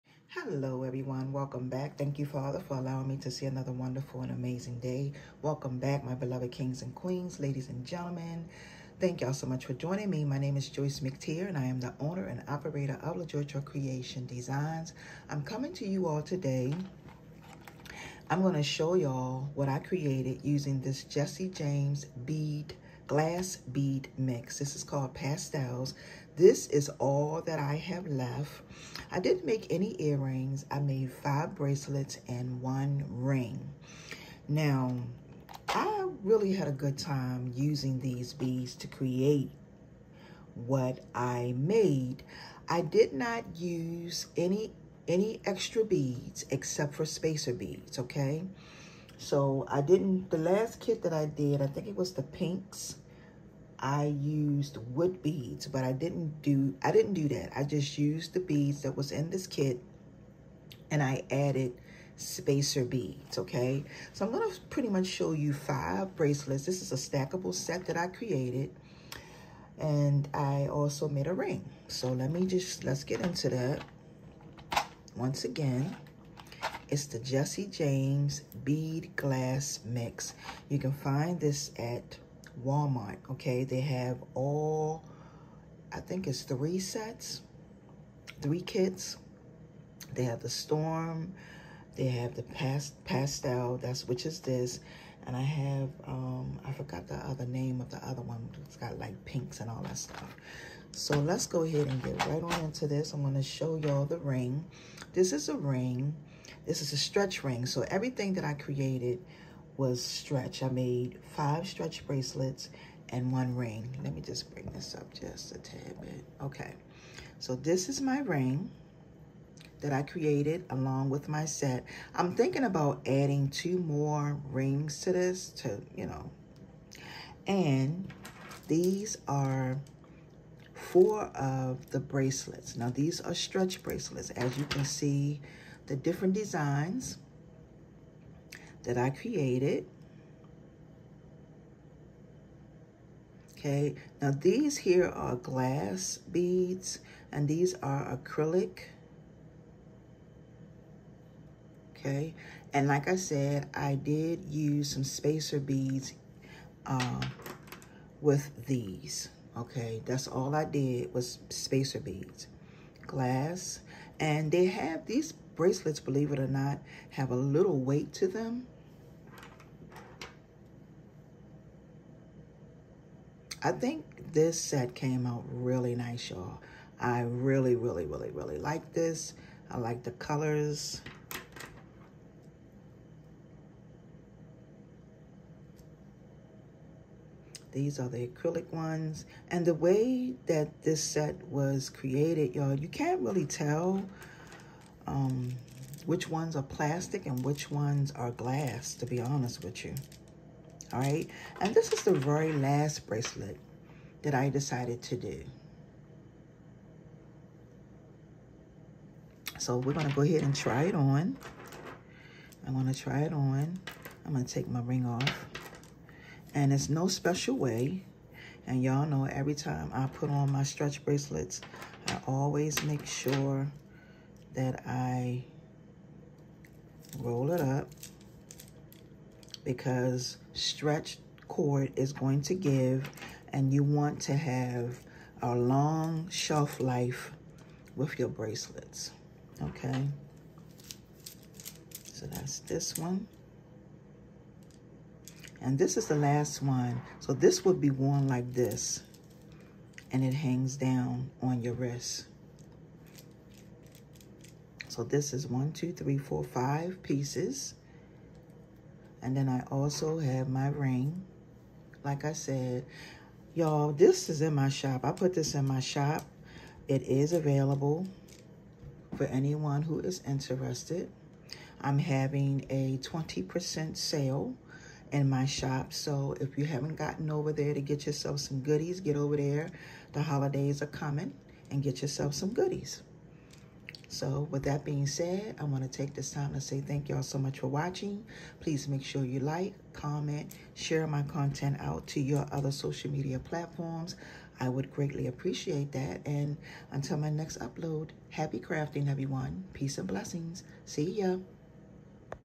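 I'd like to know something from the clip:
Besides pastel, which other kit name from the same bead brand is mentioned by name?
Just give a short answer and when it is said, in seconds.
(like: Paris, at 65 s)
Storm, at 90 s.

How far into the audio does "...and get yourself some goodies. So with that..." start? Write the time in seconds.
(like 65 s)
281 s.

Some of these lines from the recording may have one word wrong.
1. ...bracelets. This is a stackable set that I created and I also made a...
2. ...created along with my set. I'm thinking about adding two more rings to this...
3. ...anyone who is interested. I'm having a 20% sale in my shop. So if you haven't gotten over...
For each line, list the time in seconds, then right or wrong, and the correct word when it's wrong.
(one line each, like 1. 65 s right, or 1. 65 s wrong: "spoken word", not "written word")
1. 66 s right
2. 120 s right
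3. 269 s right.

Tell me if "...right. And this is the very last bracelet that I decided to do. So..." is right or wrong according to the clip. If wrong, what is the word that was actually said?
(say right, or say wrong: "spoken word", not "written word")
right.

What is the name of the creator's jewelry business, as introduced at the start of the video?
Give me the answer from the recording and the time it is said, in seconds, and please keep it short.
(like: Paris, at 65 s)
Lajoytra Creation Designs, at 13 s.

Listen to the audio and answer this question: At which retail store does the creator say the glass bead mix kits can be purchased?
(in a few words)
Walmart.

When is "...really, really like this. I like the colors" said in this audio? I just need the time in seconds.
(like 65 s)
178 s.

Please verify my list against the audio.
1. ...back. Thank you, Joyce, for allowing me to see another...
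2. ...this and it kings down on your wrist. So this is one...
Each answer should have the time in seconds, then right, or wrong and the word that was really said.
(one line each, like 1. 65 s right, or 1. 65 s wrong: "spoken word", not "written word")
1. 1 s wrong: "Father", not "Joyce"
2. 248 s wrong: "hangs", not "kings".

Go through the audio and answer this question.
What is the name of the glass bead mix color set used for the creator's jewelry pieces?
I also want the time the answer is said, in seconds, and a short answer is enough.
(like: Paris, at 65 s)
Pastels, at 25 s.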